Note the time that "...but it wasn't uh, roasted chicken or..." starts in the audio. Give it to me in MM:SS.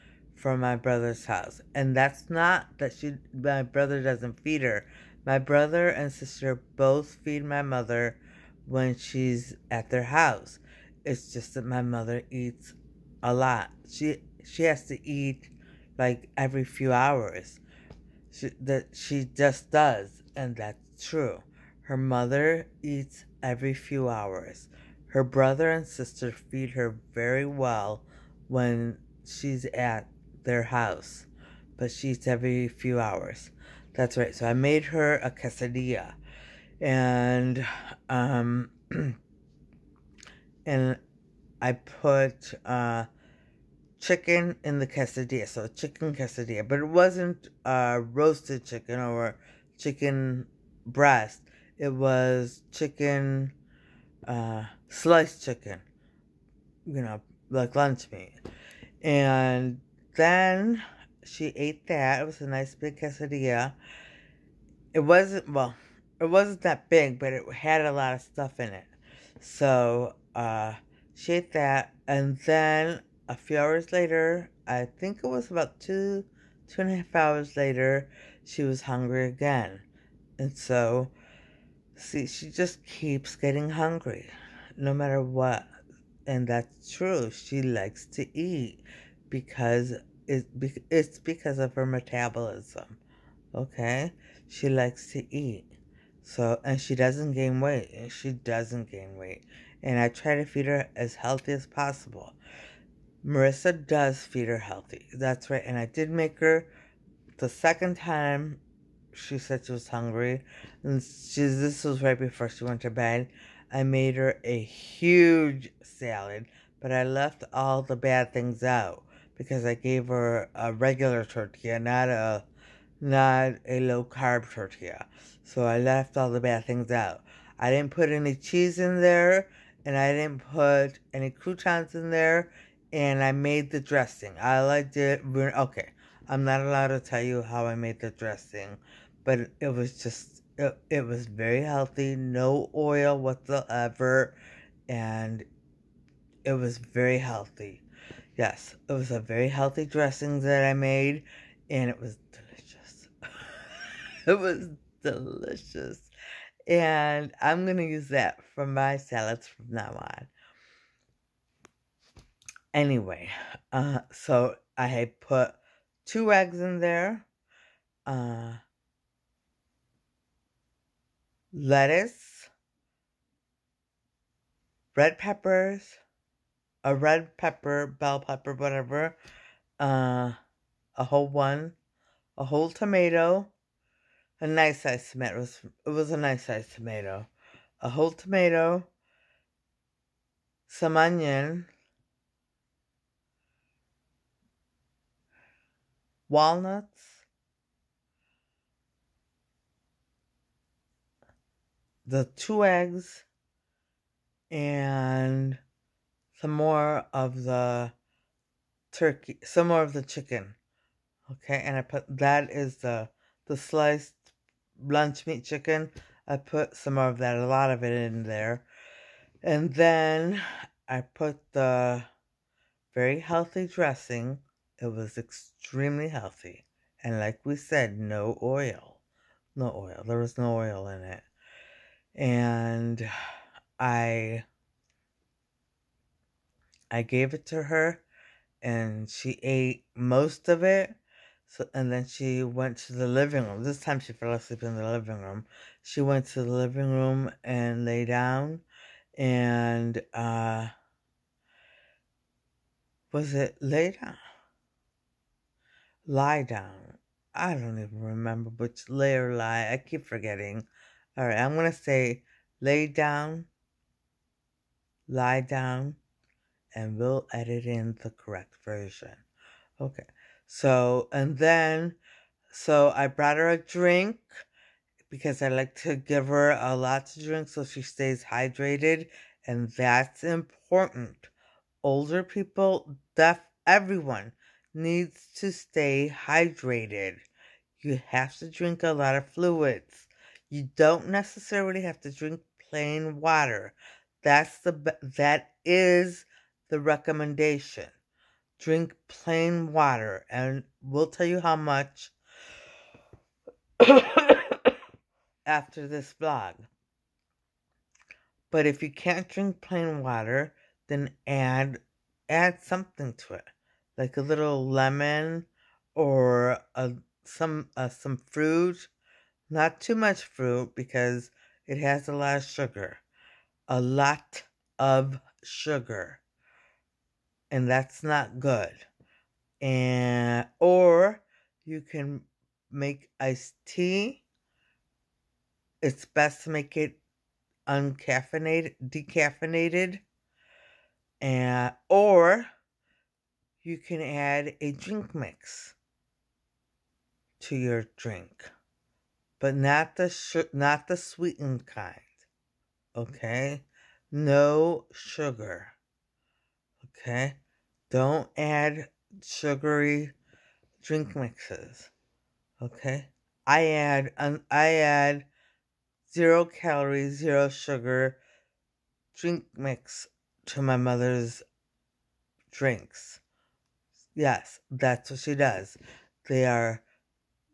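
00:46.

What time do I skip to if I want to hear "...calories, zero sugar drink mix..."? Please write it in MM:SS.
06:06.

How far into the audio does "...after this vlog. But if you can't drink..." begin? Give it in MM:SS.
05:05.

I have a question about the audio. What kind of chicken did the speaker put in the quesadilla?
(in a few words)
Sliced chicken.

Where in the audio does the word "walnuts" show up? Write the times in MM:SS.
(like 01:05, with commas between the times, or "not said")
03:16.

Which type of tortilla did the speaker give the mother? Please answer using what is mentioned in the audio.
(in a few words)
Regular tortilla.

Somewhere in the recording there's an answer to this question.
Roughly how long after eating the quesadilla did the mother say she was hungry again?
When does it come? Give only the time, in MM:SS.
01:16.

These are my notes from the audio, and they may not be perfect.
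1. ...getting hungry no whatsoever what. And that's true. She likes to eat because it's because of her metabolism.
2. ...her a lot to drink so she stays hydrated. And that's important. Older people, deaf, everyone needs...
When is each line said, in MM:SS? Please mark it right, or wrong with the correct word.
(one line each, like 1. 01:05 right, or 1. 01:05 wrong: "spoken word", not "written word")
1. 01:23 wrong: "matter", not "whatsoever"
2. 04:36 right.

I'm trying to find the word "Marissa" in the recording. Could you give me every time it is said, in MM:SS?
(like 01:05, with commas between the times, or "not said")
01:43.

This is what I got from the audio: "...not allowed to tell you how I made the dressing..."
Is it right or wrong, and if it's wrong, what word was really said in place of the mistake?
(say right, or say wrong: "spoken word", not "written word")
right.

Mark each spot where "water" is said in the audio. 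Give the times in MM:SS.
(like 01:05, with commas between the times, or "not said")
04:53, 04:59, 05:10.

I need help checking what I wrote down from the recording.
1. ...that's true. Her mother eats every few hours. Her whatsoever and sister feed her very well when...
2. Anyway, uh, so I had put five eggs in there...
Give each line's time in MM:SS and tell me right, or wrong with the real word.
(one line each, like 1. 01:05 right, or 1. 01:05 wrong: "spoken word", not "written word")
1. 00:20 wrong: "brother", not "whatsoever"
2. 02:42 wrong: "two", not "five".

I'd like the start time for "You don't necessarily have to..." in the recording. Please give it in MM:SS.
04:50.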